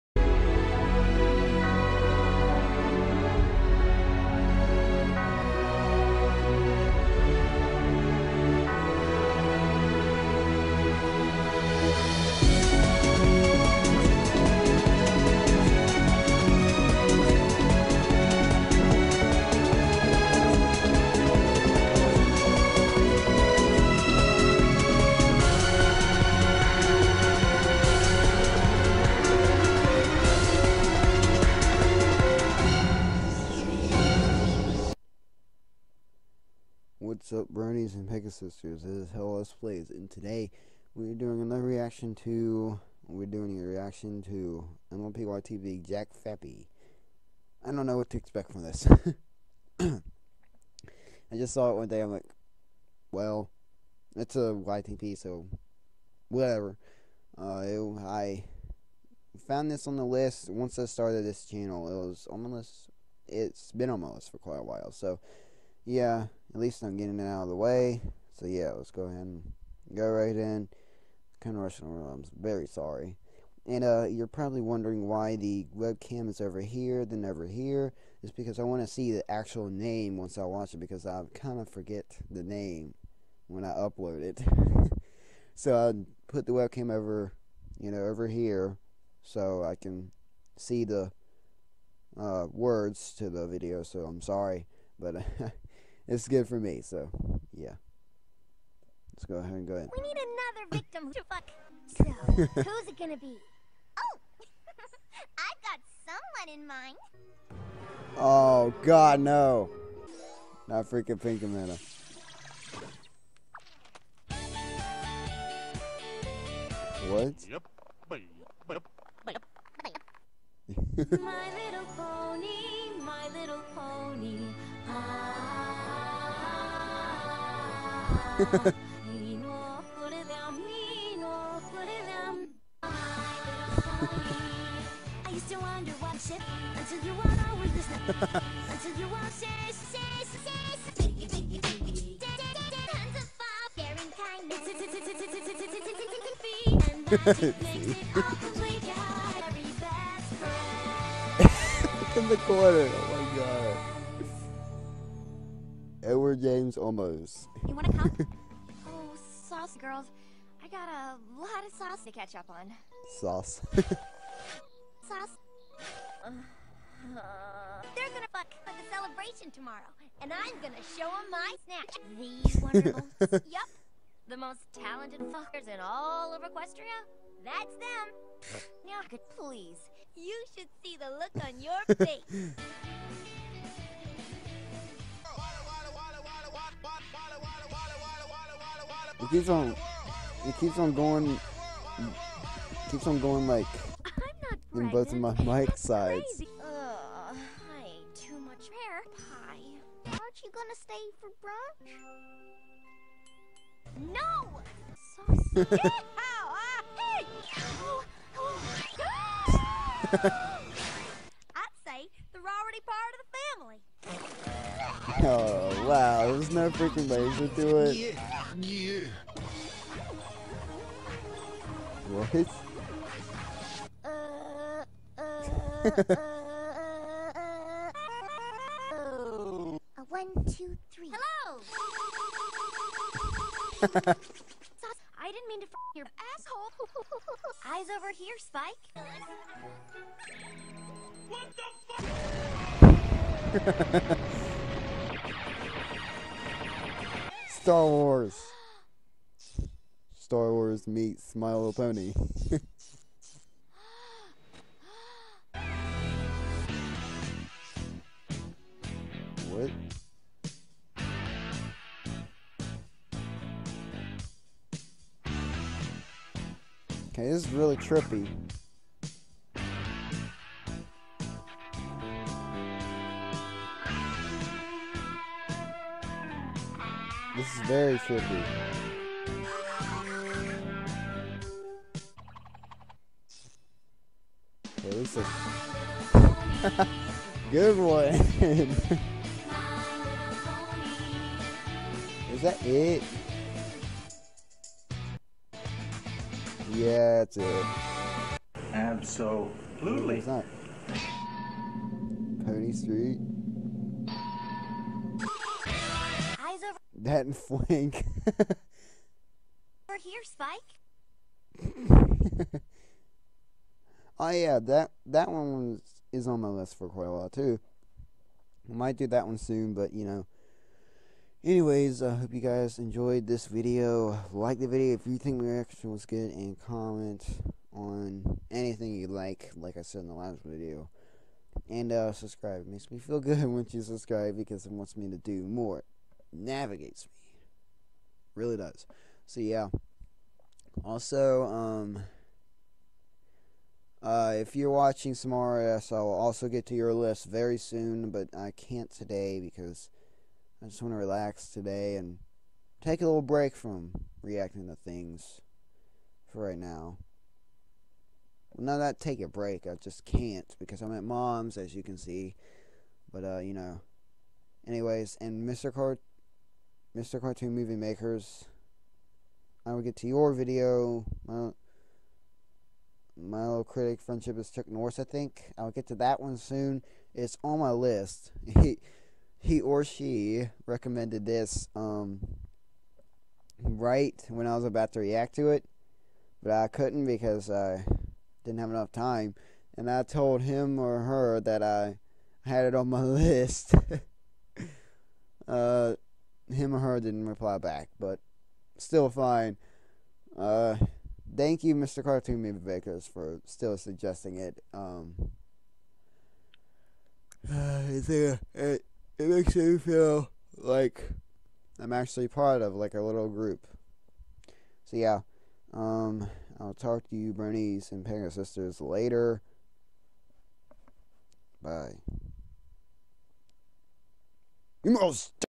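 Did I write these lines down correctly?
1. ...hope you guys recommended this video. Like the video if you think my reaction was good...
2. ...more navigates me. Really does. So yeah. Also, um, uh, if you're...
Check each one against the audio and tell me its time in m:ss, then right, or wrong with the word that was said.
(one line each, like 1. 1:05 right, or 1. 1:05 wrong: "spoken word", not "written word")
1. 5:22 wrong: "enjoyed", not "recommended"
2. 5:35 right.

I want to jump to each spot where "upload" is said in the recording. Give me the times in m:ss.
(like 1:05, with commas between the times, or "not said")
1:23.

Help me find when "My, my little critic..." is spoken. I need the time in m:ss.
6:11.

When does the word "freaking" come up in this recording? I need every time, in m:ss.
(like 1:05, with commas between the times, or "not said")
1:50, 3:36.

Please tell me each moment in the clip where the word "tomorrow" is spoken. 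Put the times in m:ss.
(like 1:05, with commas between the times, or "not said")
2:49.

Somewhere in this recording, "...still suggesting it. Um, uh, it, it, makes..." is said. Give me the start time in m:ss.
6:43.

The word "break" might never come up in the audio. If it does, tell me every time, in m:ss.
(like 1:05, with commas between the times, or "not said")
5:53, 5:59.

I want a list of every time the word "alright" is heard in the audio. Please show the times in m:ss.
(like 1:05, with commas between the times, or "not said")
not said.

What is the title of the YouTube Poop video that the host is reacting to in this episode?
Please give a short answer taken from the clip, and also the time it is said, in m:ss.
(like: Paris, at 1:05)
MLP YTP Jack Fappy, at 0:44.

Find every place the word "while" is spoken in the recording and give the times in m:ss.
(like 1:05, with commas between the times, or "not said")
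1:04, 5:17.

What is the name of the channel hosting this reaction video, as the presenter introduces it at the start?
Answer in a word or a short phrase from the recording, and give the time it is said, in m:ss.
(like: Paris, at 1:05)
Hellas Plays, at 0:39.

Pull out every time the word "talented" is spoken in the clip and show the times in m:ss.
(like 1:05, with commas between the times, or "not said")
2:54.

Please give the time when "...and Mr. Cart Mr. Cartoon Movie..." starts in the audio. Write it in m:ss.
6:05.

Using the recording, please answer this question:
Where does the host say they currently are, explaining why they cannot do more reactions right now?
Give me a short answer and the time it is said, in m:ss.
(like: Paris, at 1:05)
At mom's, at 6:00.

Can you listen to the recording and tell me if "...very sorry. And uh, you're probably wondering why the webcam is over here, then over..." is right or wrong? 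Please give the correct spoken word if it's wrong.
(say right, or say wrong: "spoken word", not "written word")
right.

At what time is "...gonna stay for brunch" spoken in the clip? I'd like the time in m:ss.
3:20.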